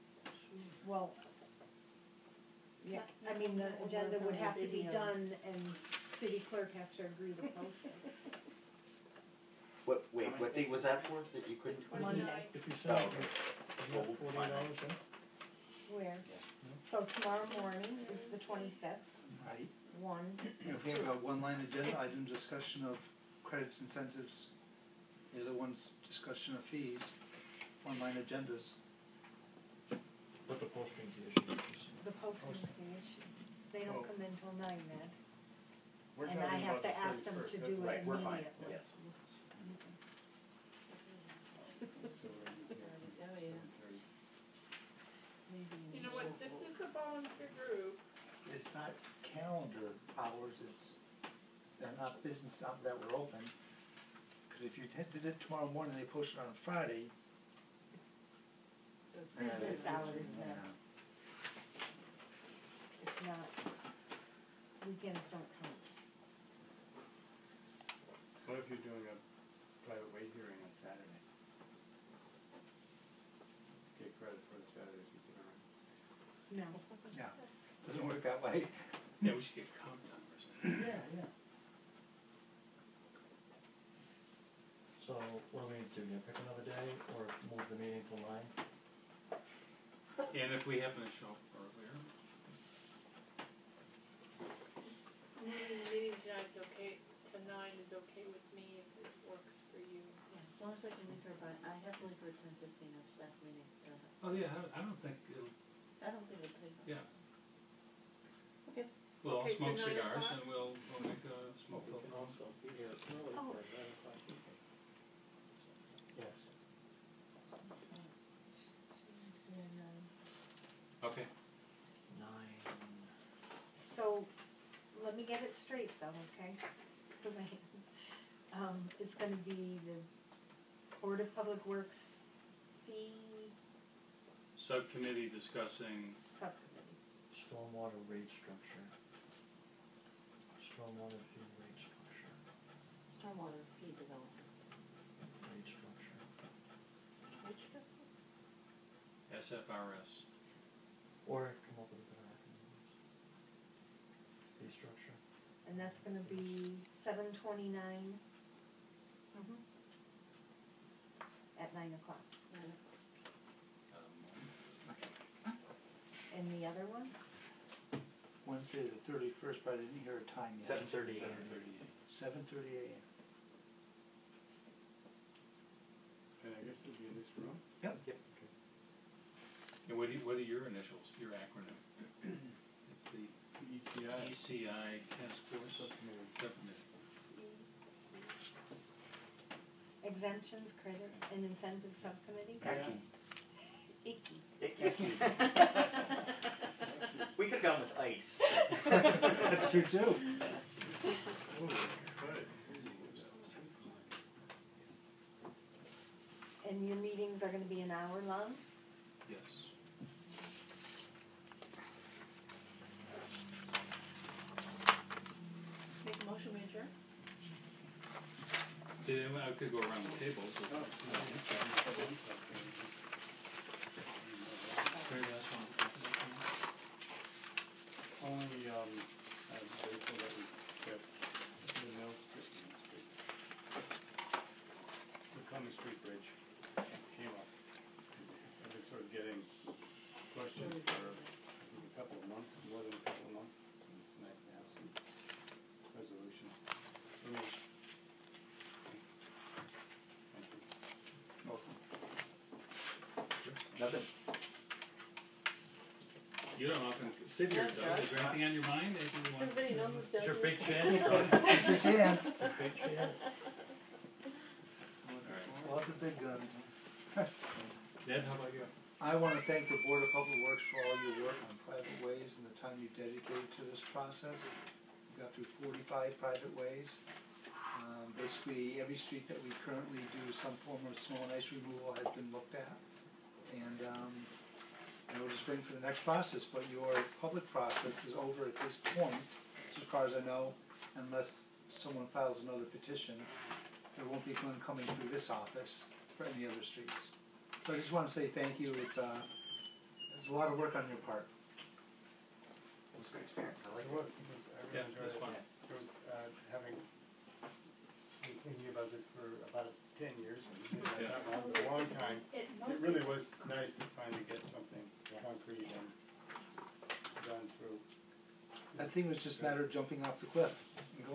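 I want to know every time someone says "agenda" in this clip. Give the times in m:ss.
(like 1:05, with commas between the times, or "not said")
0:03, 0:21, 0:28.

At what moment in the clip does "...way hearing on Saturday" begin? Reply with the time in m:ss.
1:10.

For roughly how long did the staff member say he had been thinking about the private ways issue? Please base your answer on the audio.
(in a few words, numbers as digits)
10 years.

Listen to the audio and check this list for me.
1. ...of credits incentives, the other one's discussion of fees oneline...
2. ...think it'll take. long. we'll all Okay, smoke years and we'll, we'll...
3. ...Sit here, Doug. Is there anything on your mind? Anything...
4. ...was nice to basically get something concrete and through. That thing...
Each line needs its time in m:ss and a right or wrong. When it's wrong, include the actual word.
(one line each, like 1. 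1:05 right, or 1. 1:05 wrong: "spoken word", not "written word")
1. 0:22 wrong: "online", not "oneline"
2. 1:46 wrong: "cigars", not "years"
3. 4:17 right
4. 5:13 wrong: "finally", not "basically".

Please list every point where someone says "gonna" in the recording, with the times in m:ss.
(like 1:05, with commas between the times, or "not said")
1:25, 2:35, 3:27.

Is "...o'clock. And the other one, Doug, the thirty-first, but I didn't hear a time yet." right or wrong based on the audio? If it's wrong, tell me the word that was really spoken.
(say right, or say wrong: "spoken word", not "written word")
wrong: "Wednesday", not "Doug".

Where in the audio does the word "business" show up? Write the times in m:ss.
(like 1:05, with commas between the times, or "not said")
0:52, 0:59.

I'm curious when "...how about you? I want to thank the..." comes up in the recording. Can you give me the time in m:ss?
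4:28.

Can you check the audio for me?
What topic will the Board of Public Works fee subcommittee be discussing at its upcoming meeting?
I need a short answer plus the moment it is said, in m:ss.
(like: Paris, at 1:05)
Stormwater fee rate structure, at 2:20.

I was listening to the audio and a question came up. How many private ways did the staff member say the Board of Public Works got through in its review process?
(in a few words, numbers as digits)
45.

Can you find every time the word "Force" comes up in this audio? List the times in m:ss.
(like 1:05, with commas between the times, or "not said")
3:05.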